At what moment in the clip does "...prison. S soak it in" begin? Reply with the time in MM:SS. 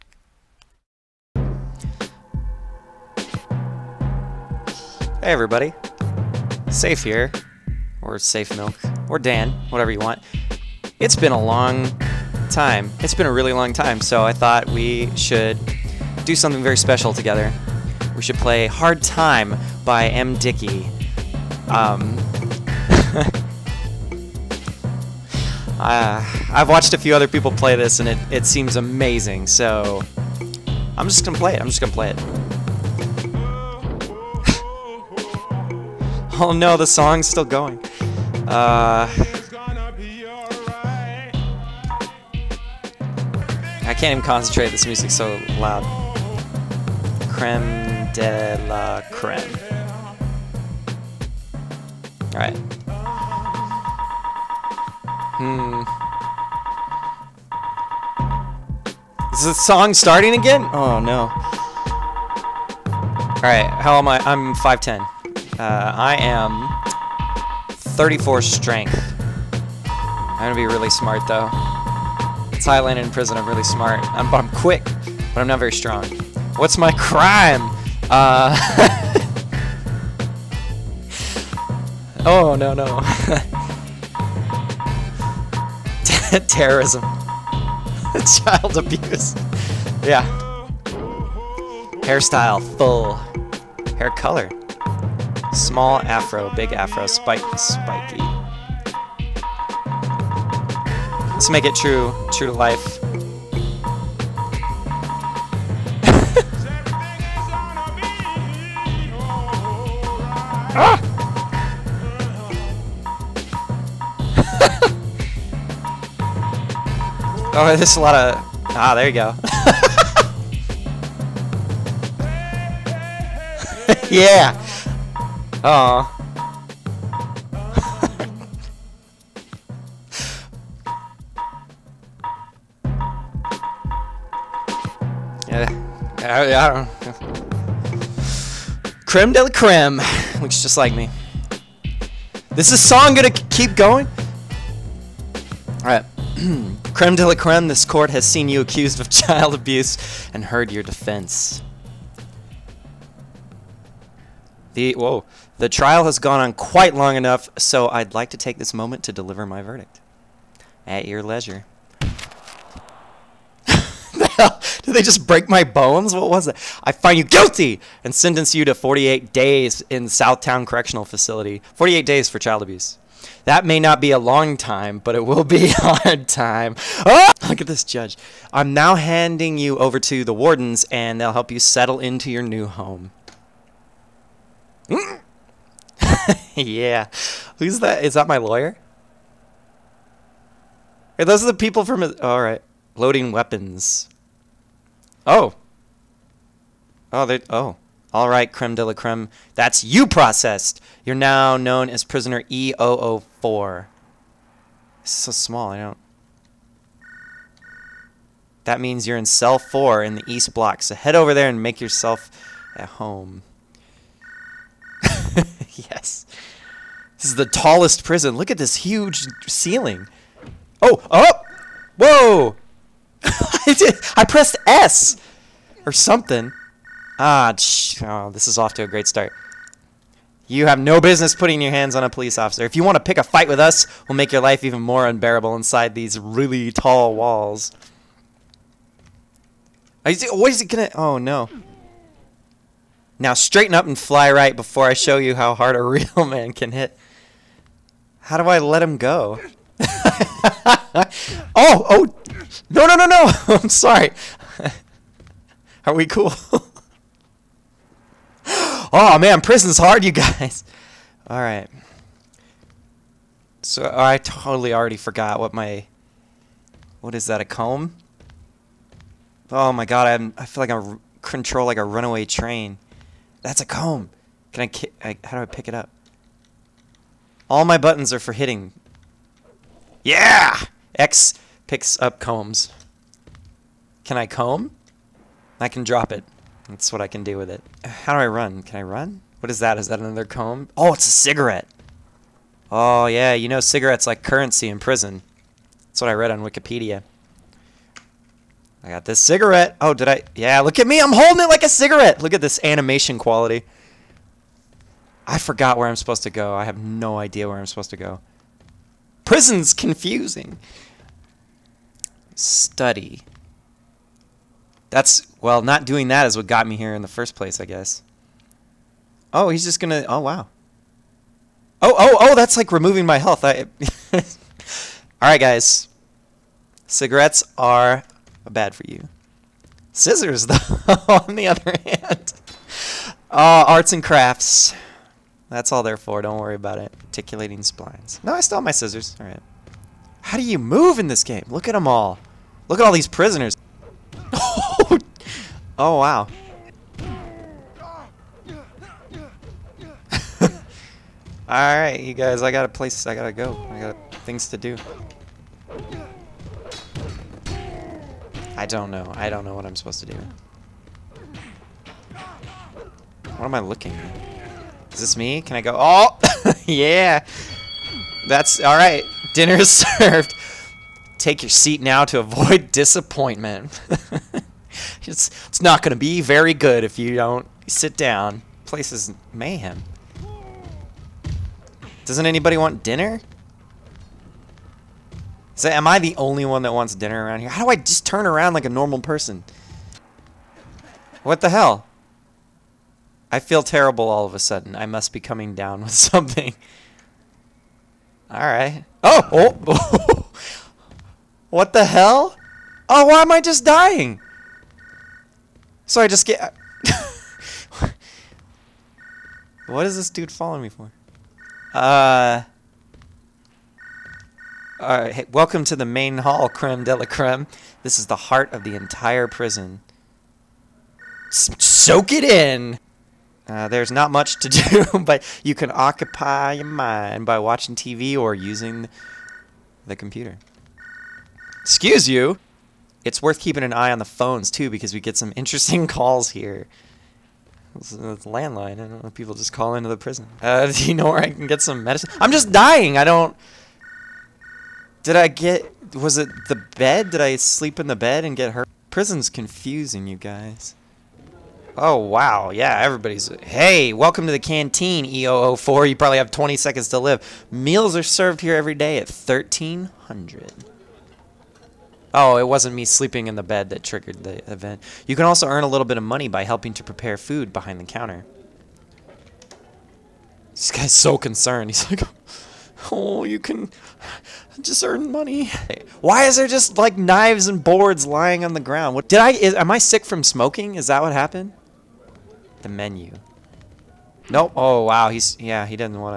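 06:59.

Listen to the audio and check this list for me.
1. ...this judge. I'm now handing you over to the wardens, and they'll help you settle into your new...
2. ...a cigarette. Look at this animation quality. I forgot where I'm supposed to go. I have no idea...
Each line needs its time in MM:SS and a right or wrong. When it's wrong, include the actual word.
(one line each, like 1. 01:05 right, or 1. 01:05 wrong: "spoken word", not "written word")
1. 02:57 right
2. 05:01 right.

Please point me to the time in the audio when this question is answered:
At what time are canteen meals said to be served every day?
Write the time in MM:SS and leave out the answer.
07:39.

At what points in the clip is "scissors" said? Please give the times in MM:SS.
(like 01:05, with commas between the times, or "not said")
05:29, 05:38.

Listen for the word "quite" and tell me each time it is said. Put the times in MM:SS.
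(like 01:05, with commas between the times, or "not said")
02:36.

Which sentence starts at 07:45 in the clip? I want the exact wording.
You can also earn a little bit of money by helping to prepare food behind the counter.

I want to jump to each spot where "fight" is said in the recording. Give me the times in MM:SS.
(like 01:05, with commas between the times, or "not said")
03:53.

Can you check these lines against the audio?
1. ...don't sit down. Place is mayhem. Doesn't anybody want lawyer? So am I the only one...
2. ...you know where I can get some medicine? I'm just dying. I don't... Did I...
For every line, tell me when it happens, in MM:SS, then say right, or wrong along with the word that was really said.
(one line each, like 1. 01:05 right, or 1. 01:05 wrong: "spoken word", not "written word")
1. 06:17 wrong: "dinner", not "lawyer"
2. 07:20 right.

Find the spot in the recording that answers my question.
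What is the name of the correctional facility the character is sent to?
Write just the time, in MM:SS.
02:50.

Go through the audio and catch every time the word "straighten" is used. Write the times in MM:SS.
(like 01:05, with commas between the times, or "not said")
04:03.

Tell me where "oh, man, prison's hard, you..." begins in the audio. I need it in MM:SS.
04:18.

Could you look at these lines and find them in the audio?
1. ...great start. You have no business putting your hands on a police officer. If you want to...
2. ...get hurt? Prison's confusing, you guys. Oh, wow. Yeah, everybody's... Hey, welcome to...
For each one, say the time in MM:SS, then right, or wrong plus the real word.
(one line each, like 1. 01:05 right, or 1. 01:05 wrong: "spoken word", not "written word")
1. 03:48 right
2. 07:28 right.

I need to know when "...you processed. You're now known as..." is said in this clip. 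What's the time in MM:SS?
03:19.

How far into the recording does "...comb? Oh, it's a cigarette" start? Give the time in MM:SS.
04:50.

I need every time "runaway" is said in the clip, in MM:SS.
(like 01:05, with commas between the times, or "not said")
04:31.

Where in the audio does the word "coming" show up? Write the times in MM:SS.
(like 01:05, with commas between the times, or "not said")
06:35.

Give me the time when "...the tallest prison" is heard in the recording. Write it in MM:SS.
03:37.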